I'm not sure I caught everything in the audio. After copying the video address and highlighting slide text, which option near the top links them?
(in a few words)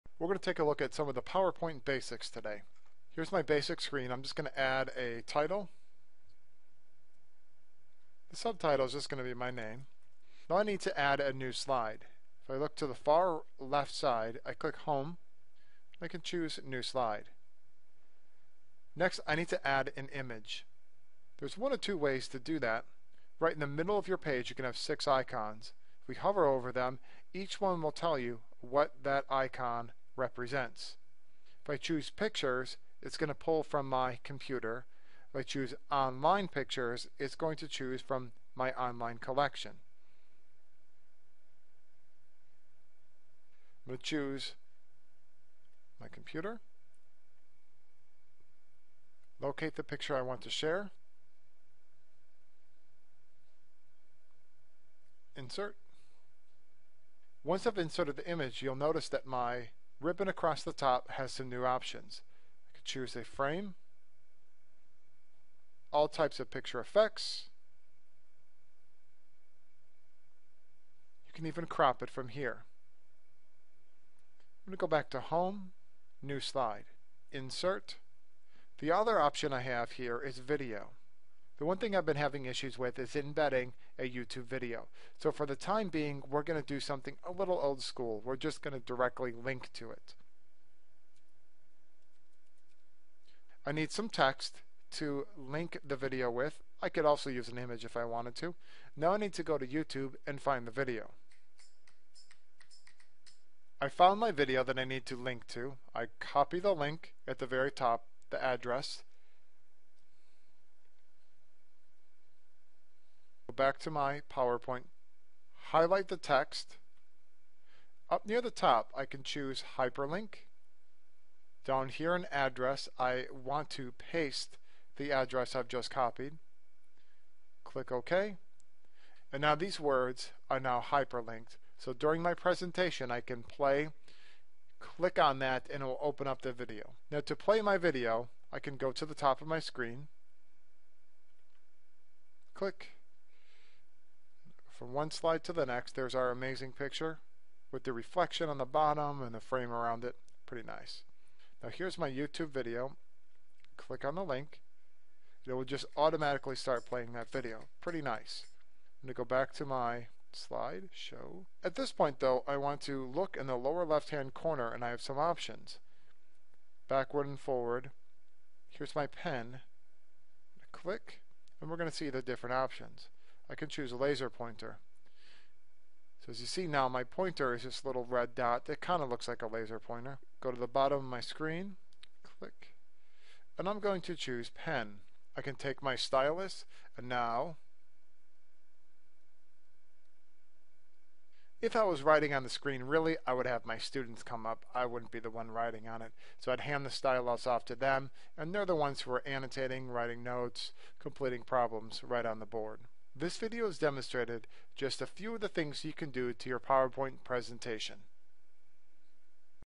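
hyperlink.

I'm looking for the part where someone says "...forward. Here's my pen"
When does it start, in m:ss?
2:47.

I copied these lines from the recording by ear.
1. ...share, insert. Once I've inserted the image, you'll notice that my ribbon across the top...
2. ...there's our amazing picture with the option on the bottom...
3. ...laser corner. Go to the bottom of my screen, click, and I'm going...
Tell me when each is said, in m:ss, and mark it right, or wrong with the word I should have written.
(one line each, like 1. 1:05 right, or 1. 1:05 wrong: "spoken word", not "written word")
1. 0:50 right
2. 2:25 wrong: "reflection", not "option"
3. 2:59 wrong: "pointer", not "corner".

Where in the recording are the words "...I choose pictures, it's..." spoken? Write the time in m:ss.
0:31.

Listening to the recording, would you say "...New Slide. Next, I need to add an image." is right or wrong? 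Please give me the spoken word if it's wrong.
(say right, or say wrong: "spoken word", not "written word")
right.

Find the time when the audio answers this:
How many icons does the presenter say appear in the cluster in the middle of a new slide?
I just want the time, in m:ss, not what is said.
0:24.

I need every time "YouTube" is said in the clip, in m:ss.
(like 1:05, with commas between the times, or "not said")
1:24, 1:39, 2:32.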